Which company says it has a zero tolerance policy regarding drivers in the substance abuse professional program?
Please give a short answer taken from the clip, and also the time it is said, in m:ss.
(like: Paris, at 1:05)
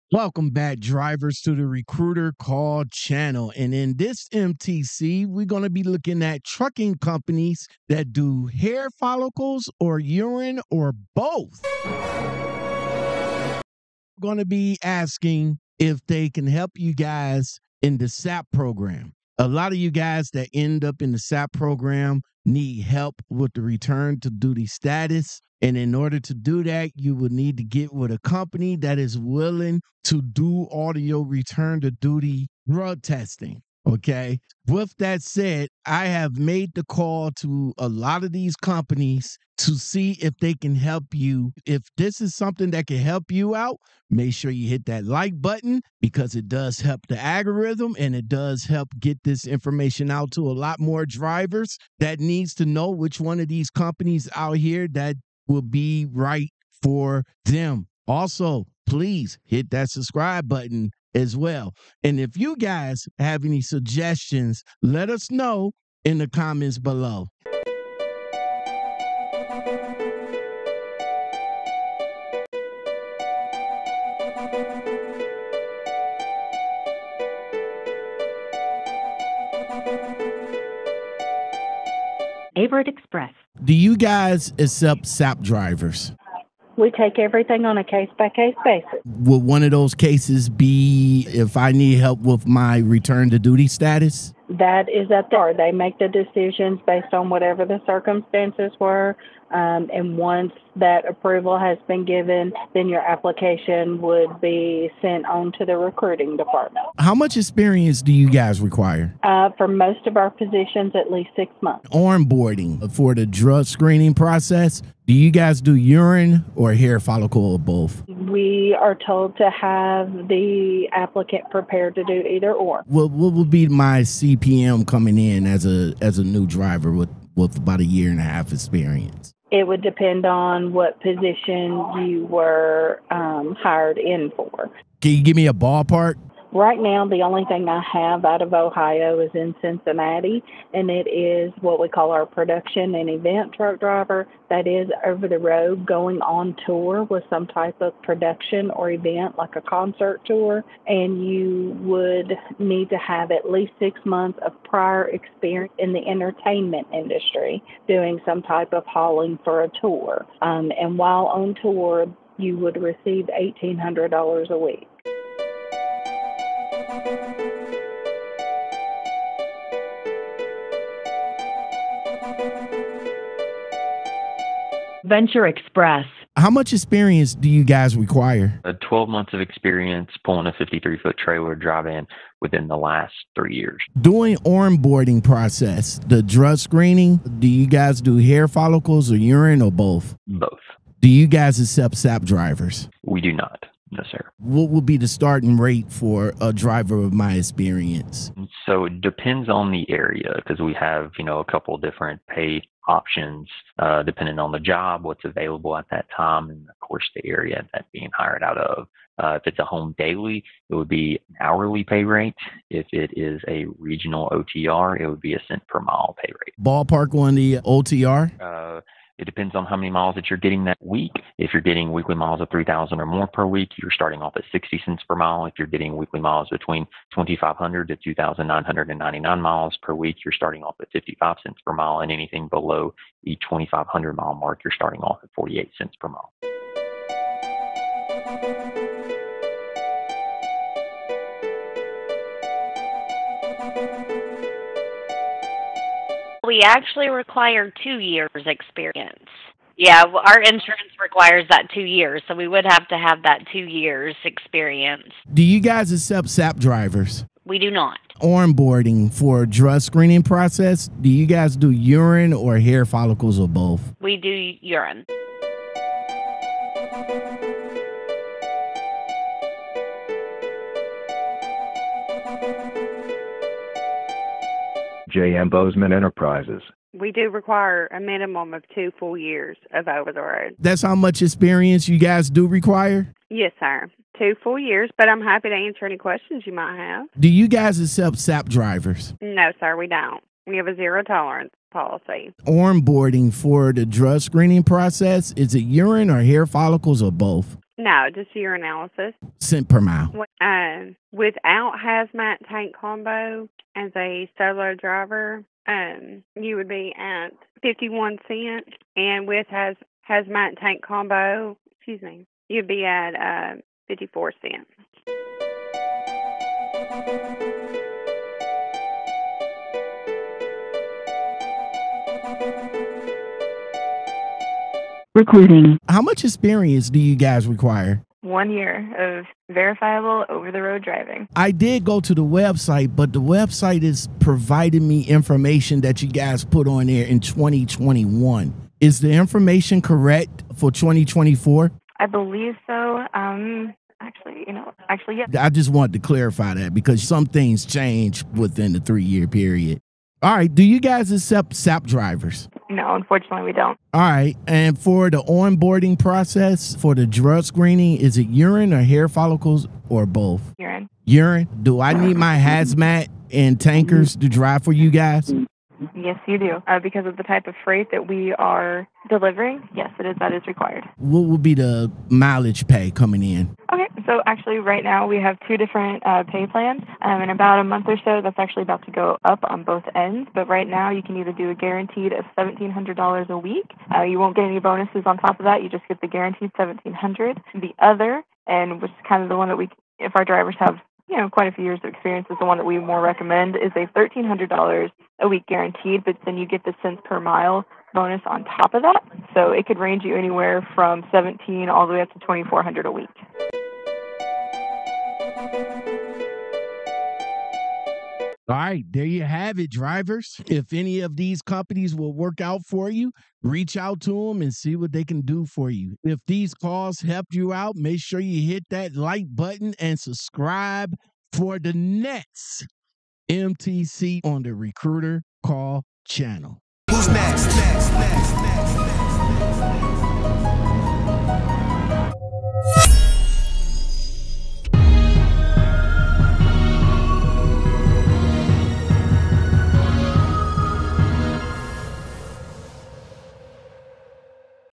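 J.M. Bozeman Enterprises, at 4:35.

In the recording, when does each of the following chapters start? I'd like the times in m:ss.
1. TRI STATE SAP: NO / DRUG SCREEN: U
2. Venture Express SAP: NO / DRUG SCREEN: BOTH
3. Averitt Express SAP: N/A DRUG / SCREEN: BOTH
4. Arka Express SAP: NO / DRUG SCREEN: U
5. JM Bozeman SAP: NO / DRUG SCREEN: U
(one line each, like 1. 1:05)
1. 5:16
2. 2:44
3. 1:22
4. 3:56
5. 4:26.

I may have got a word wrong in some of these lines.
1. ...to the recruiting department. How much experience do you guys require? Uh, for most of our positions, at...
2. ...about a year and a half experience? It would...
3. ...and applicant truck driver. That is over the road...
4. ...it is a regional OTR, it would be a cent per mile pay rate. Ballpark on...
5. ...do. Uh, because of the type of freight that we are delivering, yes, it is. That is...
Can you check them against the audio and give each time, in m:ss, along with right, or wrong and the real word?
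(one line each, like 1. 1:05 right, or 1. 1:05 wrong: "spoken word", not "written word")
1. 1:45 right
2. 2:07 right
3. 2:22 wrong: "event", not "applicant"
4. 3:32 right
5. 6:06 right.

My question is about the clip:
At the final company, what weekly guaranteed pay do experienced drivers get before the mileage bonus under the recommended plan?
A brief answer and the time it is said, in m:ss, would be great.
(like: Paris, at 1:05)
$1,300, at 6:33.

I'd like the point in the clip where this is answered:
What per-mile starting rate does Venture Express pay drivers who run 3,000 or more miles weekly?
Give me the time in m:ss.
3:44.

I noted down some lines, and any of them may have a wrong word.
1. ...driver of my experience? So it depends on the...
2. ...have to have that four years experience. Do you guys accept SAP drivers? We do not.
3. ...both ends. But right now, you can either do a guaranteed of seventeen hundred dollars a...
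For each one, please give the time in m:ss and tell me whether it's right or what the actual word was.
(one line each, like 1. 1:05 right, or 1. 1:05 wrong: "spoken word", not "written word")
1. 3:16 right
2. 4:12 wrong: "two", not "four"
3. 6:19 right.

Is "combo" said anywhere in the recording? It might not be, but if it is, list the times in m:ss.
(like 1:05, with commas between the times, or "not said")
5:02, 5:10.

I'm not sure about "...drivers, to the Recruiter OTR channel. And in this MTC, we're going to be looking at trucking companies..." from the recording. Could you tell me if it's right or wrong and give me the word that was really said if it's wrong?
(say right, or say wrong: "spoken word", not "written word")
wrong: "Call", not "OTR".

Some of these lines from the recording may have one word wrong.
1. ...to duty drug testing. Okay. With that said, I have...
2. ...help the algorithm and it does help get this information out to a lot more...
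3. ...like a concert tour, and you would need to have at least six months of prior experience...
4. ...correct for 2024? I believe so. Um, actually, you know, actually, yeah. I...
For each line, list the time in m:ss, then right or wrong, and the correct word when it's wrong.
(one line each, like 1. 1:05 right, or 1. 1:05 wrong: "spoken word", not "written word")
1. 0:31 right
2. 0:46 right
3. 2:29 right
4. 5:39 right.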